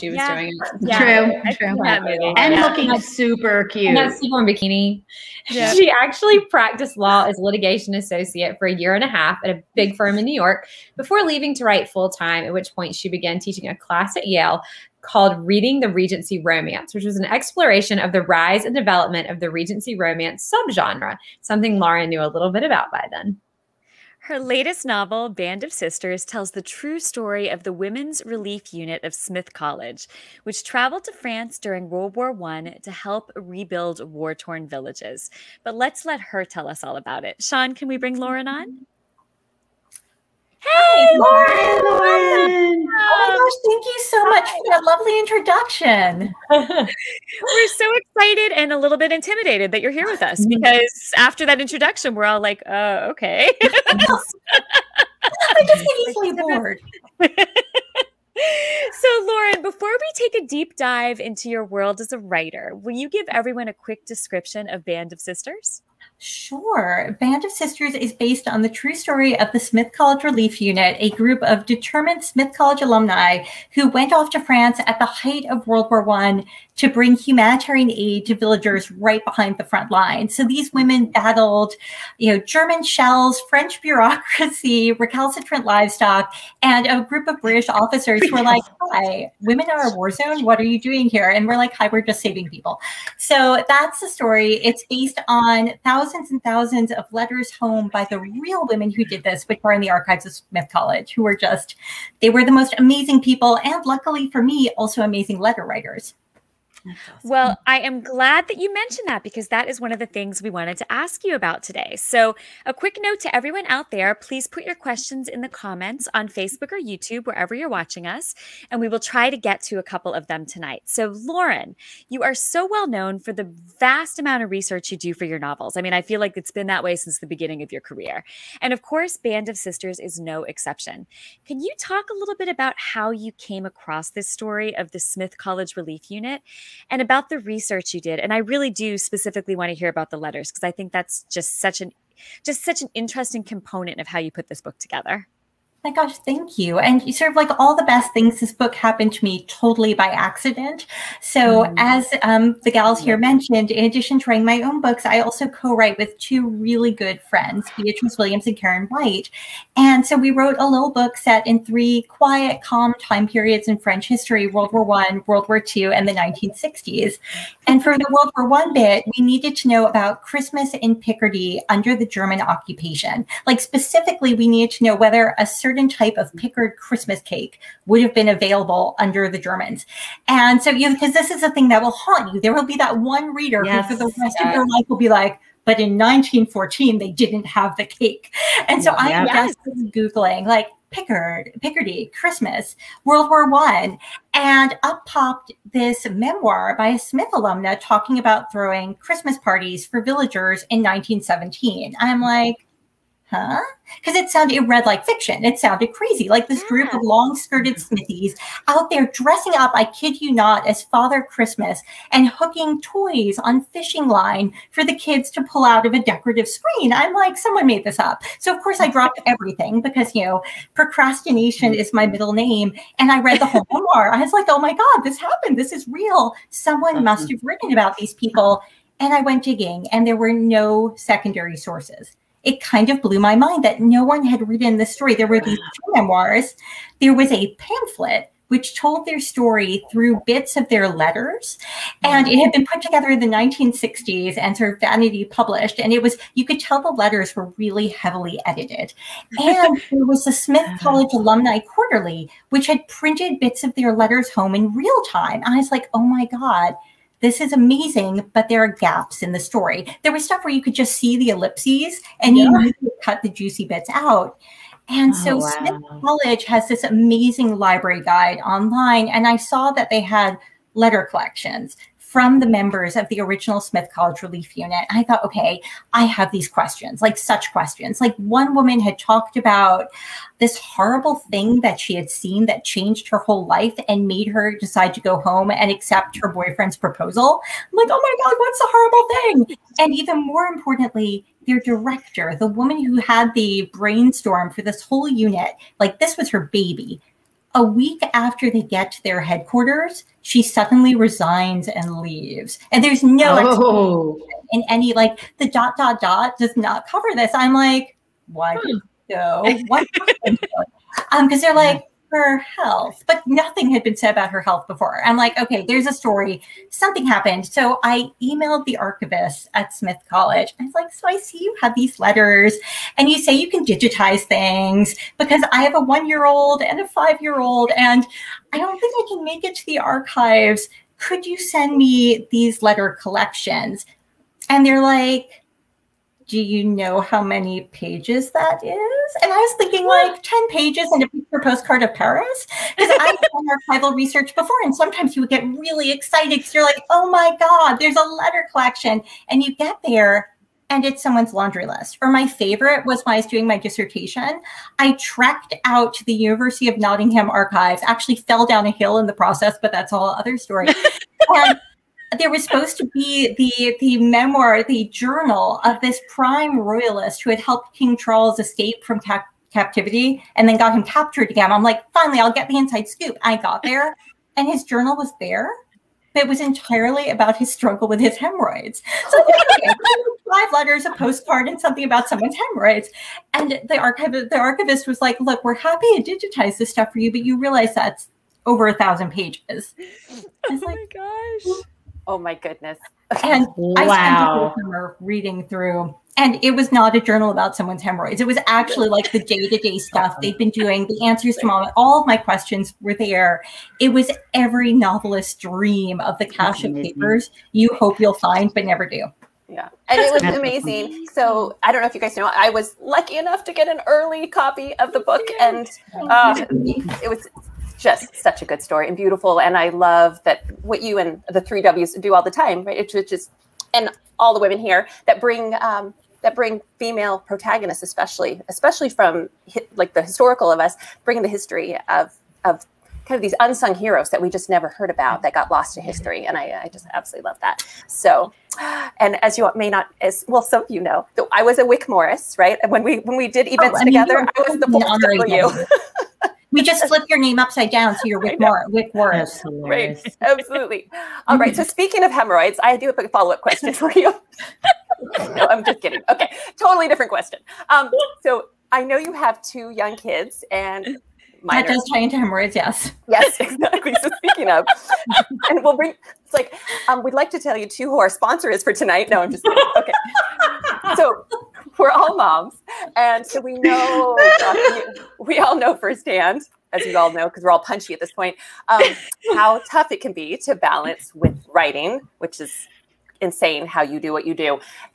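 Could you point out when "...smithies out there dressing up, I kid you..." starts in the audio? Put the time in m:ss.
3:27.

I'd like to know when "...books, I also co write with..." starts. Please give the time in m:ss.
2:34.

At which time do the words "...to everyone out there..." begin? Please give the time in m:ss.
1:53.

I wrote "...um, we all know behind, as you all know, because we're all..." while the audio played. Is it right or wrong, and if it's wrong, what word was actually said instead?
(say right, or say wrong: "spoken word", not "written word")
wrong: "firsthand", not "behind".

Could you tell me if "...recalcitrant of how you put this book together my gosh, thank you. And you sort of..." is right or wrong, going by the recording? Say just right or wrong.
wrong.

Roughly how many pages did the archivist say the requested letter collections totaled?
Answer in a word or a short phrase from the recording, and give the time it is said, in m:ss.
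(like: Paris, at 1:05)
over 1,000 pages, at 6:28.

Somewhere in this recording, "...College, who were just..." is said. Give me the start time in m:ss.
1:40.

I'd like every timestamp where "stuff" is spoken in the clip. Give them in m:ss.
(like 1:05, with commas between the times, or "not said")
4:20, 6:26, 6:39.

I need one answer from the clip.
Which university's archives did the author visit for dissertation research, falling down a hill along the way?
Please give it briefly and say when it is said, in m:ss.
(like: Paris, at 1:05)
University of Nottingham, at 5:56.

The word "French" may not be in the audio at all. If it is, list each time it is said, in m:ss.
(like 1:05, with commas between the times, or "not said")
1:23, 2:43.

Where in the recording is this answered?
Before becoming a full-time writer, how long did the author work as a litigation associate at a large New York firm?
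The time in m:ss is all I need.
0:08.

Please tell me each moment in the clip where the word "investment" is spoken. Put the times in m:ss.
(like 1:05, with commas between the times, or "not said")
not said.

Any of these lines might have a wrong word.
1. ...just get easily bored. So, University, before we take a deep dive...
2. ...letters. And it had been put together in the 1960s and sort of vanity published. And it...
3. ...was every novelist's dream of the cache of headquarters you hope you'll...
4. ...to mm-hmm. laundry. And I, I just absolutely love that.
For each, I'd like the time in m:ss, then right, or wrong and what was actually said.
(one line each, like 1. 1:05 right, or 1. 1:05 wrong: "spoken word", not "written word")
1. 0:55 wrong: "Lauren", not "University"
2. 4:00 right
3. 6:43 wrong: "papers", not "headquarters"
4. 7:15 wrong: "history", not "laundry".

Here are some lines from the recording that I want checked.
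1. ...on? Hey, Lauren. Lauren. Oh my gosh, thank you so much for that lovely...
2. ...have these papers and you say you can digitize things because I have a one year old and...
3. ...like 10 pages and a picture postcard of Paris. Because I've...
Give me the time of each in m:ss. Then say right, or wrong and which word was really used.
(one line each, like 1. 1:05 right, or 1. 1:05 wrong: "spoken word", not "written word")
1. 0:38 right
2. 5:21 wrong: "letters", not "papers"
3. 5:39 right.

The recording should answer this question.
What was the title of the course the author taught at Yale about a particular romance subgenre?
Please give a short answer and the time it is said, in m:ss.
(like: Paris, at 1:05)
Reading the Regency Romance, at 0:15.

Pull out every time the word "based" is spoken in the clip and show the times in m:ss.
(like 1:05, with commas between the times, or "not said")
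1:08, 1:34.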